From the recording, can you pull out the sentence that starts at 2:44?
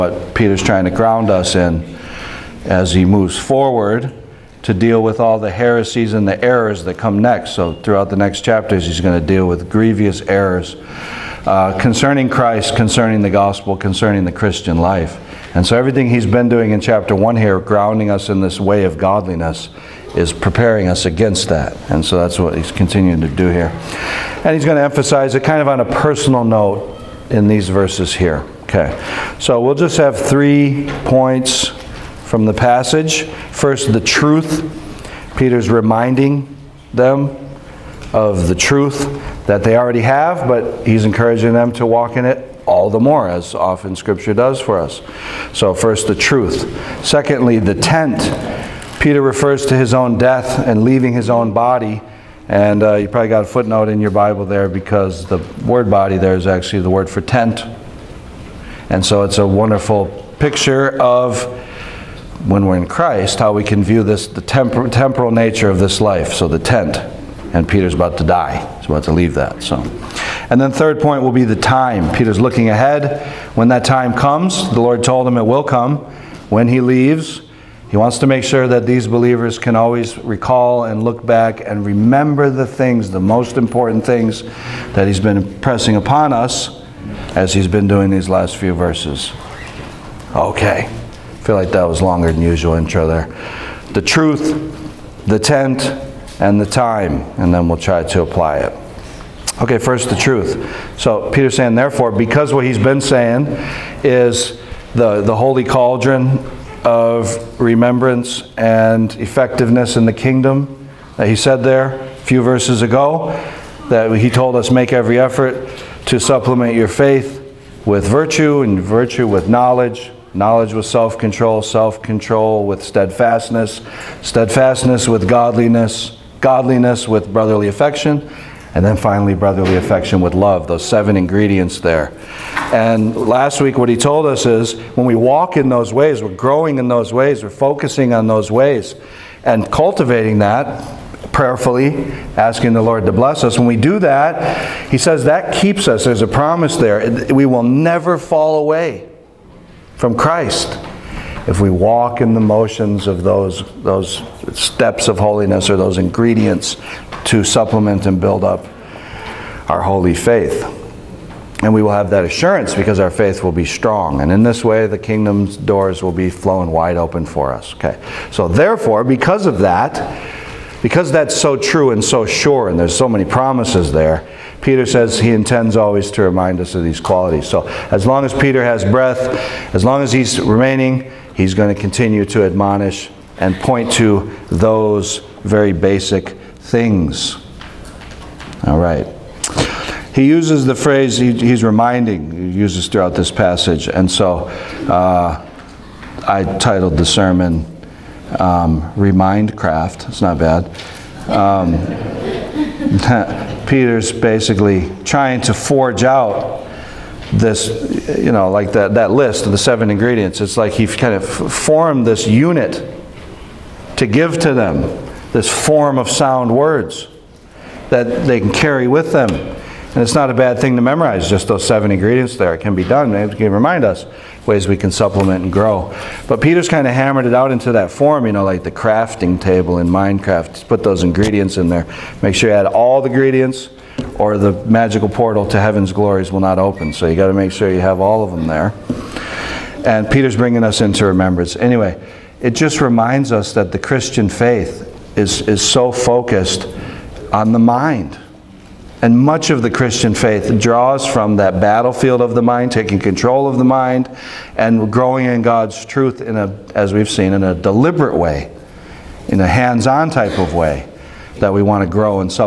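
And in this way, the kingdom's doors will be flown wide open for us.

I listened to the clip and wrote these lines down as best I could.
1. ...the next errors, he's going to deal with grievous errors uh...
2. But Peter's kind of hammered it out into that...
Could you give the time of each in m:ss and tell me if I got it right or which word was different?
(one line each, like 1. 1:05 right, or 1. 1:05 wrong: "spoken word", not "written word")
1. 0:08 wrong: "chapters", not "errors"
2. 3:46 right.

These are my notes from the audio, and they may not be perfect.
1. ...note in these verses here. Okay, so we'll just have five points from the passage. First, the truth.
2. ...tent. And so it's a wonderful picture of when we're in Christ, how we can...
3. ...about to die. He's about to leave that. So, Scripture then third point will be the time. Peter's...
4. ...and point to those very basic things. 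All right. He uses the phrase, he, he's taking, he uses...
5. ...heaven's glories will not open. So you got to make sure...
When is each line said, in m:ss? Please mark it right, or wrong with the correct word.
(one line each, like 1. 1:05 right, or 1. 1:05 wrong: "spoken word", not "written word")
1. 0:26 wrong: "three", not "five"
2. 0:57 right
3. 1:07 wrong: "And", not "Scripture"
4. 3:03 wrong: "reminding", not "taking"
5. 3:55 right.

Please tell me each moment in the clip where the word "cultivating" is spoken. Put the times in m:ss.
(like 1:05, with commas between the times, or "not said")
2:19.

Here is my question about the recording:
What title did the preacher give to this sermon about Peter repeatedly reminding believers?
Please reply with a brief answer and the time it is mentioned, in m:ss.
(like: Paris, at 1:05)
Remindcraft, at 3:18.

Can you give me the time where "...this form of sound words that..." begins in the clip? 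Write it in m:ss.
3:35.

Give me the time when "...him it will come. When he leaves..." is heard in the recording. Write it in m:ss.
1:15.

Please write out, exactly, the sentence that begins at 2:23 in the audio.
When we do that, he says that keeps us.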